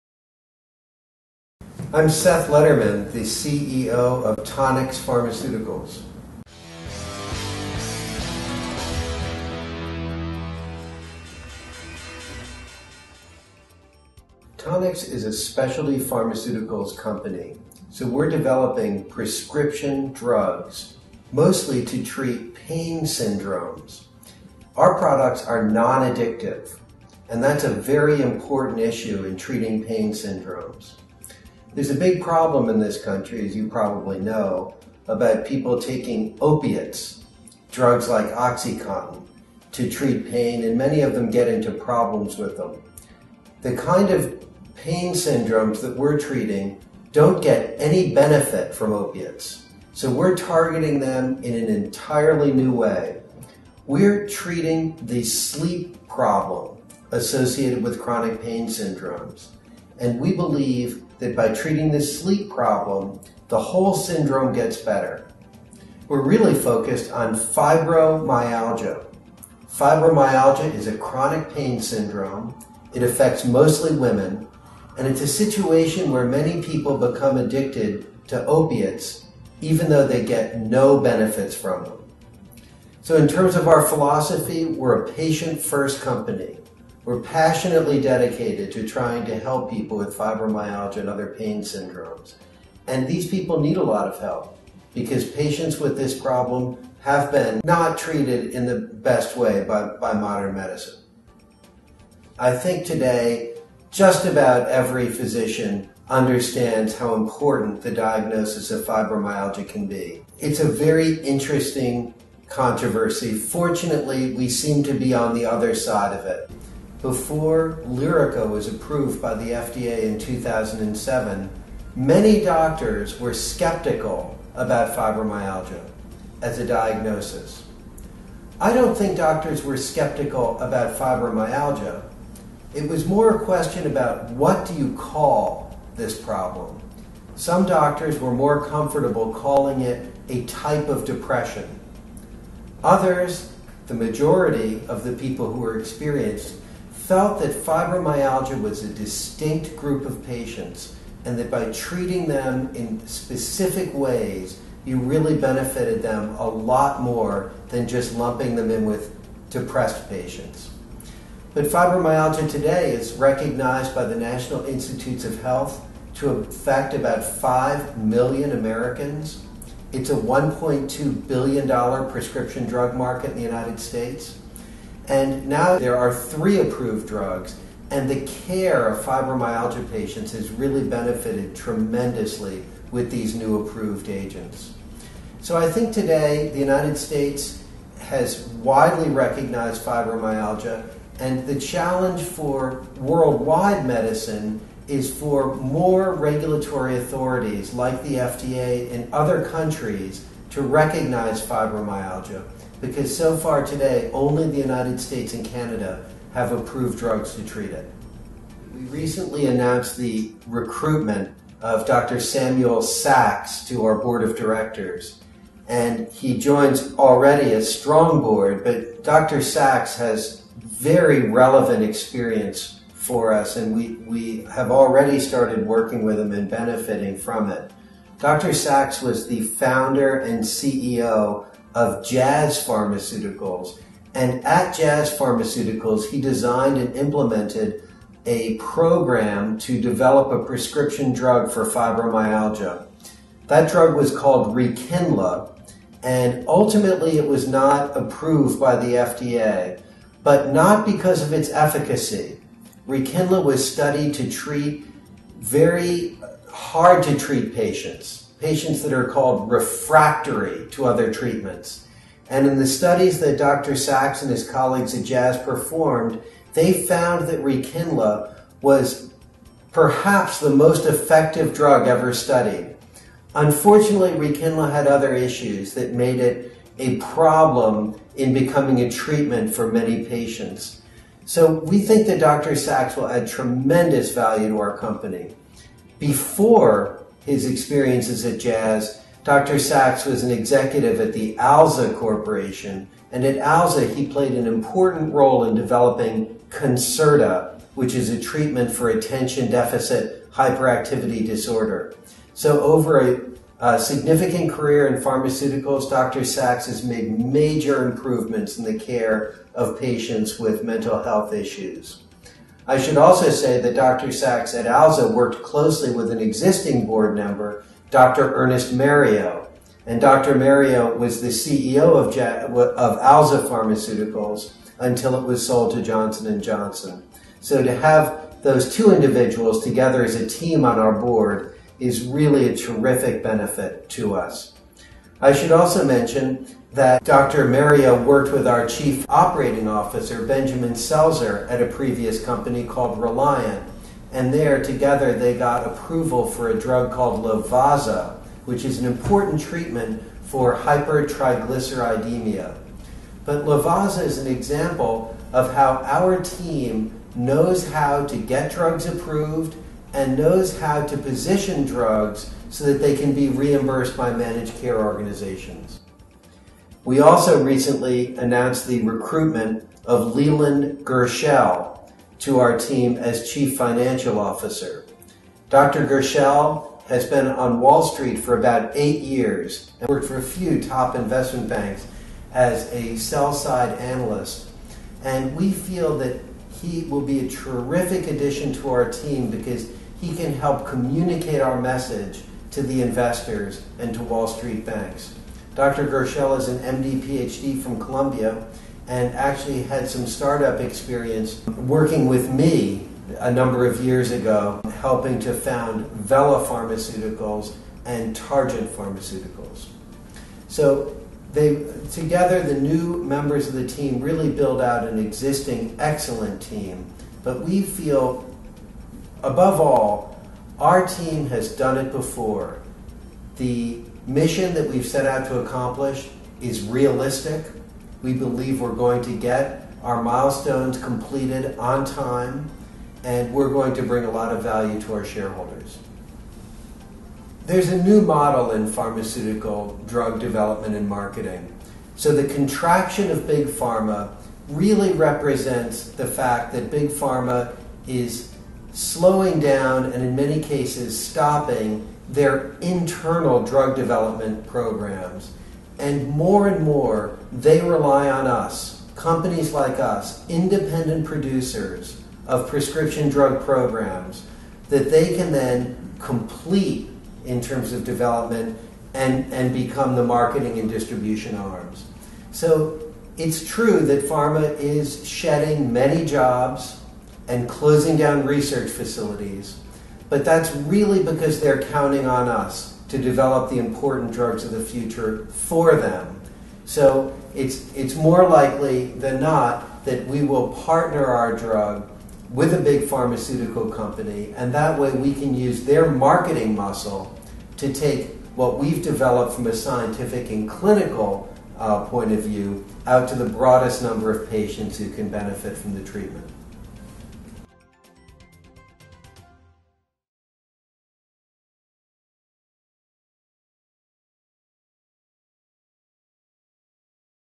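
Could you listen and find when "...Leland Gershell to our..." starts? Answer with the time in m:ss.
6:10.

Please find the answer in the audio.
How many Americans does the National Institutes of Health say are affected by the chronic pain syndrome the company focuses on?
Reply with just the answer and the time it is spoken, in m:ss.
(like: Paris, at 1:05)
5 million, at 2:47.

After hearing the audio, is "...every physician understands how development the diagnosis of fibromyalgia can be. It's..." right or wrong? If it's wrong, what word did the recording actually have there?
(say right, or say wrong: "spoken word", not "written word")
wrong: "important", not "development".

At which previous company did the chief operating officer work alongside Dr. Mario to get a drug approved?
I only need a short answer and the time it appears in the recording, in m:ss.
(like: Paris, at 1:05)
Reliant, at 5:42.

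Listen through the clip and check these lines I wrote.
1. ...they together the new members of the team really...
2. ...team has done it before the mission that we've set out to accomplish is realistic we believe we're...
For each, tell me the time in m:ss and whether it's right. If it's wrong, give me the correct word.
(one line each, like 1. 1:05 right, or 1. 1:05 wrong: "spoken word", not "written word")
1. 6:51 right
2. 7:00 right.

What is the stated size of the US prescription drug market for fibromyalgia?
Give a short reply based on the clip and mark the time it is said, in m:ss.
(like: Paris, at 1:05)
$1.2 billion, at 2:50.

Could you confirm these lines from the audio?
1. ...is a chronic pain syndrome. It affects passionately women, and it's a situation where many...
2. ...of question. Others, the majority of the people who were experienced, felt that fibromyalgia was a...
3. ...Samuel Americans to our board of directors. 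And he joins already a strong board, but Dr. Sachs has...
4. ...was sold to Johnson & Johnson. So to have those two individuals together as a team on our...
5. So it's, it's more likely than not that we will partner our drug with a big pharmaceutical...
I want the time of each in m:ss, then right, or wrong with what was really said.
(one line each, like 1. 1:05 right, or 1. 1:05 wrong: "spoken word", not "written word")
1. 1:10 wrong: "mostly", not "passionately"
2. 2:20 wrong: "depression", not "question"
3. 3:32 wrong: "Sachs", not "Americans"
4. 5:25 right
5. 8:06 right.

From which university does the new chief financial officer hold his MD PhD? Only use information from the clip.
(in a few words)
Columbia.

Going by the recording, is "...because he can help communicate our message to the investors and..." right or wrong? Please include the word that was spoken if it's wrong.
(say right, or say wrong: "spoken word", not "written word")
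right.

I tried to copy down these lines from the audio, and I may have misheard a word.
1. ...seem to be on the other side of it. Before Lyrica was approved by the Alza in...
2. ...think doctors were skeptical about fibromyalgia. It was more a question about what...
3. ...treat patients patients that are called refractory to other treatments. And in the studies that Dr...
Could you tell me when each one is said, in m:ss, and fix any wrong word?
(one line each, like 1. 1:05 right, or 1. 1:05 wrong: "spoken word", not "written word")
1. 1:54 wrong: "FDA", not "Alza"
2. 2:08 right
3. 4:17 right.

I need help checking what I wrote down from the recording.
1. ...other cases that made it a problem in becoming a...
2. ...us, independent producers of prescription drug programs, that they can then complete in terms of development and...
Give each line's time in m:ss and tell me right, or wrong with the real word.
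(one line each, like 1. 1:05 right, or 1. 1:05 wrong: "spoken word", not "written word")
1. 4:34 wrong: "issues", not "cases"
2. 7:39 right.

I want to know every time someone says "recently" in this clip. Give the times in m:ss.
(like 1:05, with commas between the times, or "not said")
3:28, 6:07.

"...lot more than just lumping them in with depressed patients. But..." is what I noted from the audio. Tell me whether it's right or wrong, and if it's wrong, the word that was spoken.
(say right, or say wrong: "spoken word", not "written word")
right.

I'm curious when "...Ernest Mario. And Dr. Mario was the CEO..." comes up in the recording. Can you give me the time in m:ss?
5:18.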